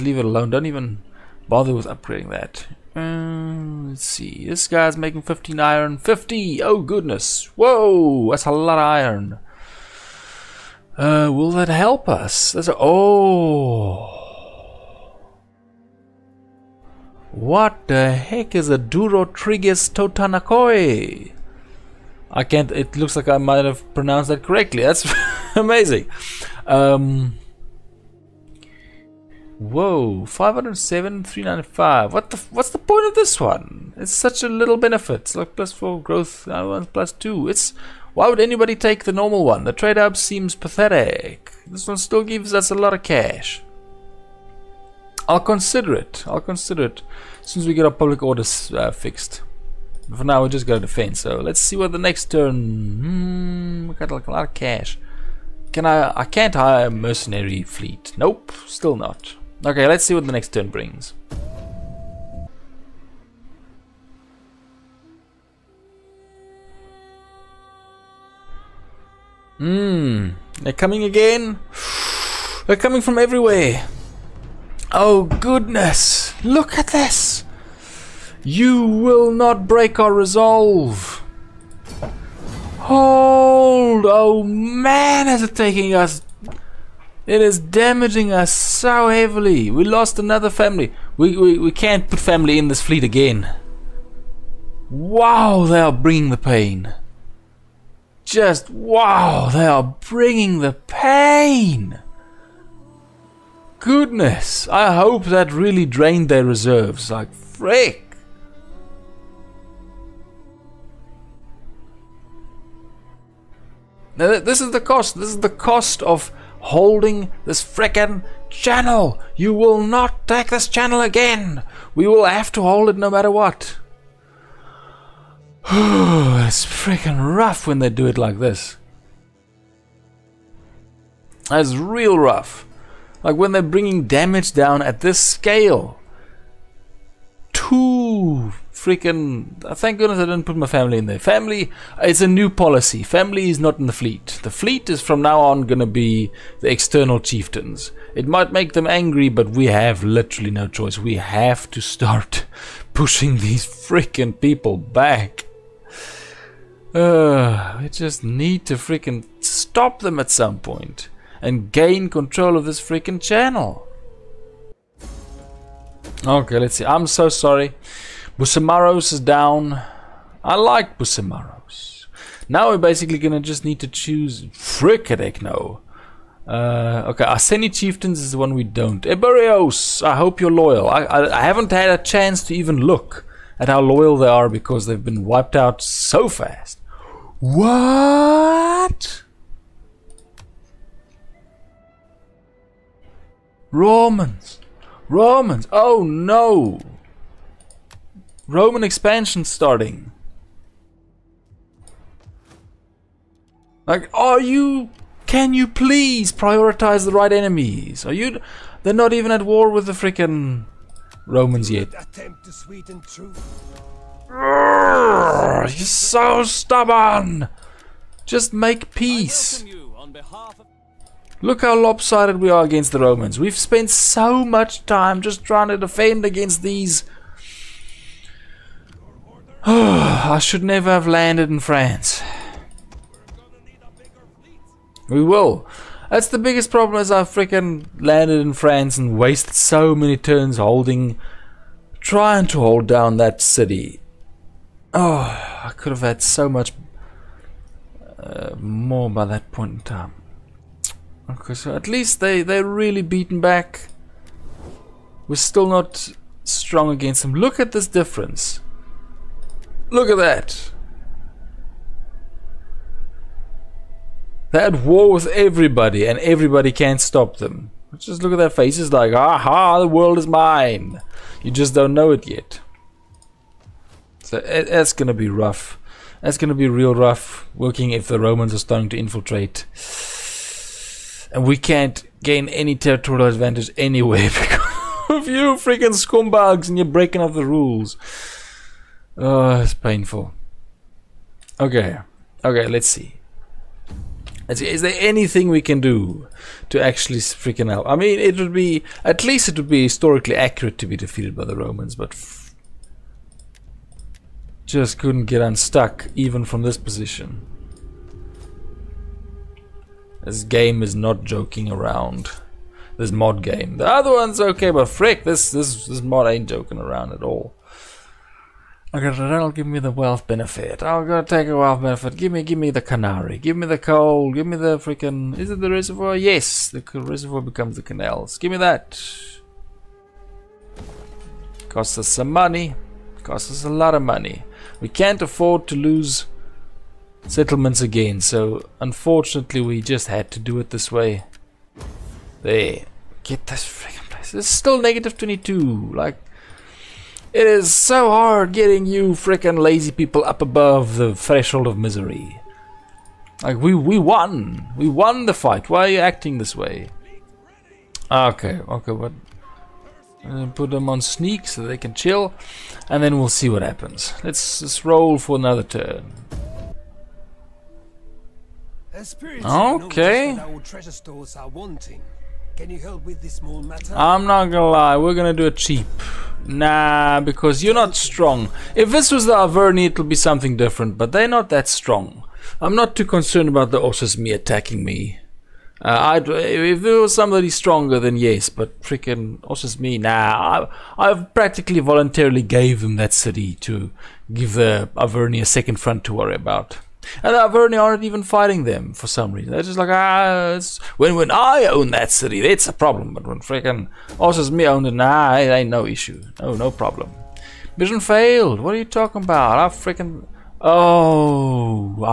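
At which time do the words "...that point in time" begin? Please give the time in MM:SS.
04:09.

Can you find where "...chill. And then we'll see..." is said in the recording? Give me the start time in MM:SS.
06:01.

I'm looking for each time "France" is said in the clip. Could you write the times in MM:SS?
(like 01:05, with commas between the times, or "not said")
03:51, 03:58.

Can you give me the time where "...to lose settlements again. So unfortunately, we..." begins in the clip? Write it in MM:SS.
05:35.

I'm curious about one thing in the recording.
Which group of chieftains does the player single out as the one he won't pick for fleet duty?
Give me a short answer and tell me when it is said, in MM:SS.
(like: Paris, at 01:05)
Arseni Chieftains, at 02:57.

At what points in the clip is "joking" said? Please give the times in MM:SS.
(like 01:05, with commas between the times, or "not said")
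05:11, 05:16.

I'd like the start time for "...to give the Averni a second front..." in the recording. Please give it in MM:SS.
06:33.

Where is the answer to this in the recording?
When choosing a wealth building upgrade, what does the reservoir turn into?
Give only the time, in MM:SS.
05:27.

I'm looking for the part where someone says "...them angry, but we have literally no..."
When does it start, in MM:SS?
02:28.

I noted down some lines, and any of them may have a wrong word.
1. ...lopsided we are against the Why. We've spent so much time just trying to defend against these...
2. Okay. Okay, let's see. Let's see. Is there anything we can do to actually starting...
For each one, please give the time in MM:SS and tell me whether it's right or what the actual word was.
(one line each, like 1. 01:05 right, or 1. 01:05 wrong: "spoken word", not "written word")
1. 03:41 wrong: "Romans", not "Why"
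2. 04:51 wrong: "freaking", not "starting".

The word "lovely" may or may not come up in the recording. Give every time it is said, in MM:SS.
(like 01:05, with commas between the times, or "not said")
not said.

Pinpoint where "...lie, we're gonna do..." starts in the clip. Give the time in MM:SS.
06:14.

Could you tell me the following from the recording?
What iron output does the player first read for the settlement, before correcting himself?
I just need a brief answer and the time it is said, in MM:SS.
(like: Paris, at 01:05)
15, at 00:05.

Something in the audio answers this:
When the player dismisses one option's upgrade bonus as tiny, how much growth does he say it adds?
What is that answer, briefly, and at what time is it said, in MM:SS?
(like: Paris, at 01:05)
plus 4, at 00:35.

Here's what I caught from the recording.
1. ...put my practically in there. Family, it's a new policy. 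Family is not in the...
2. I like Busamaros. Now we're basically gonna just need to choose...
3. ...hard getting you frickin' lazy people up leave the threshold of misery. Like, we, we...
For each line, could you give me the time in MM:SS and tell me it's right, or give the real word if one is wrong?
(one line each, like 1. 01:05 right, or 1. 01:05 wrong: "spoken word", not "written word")
1. 02:20 wrong: "family", not "practically"
2. 02:50 right
3. 05:48 wrong: "above", not "leave".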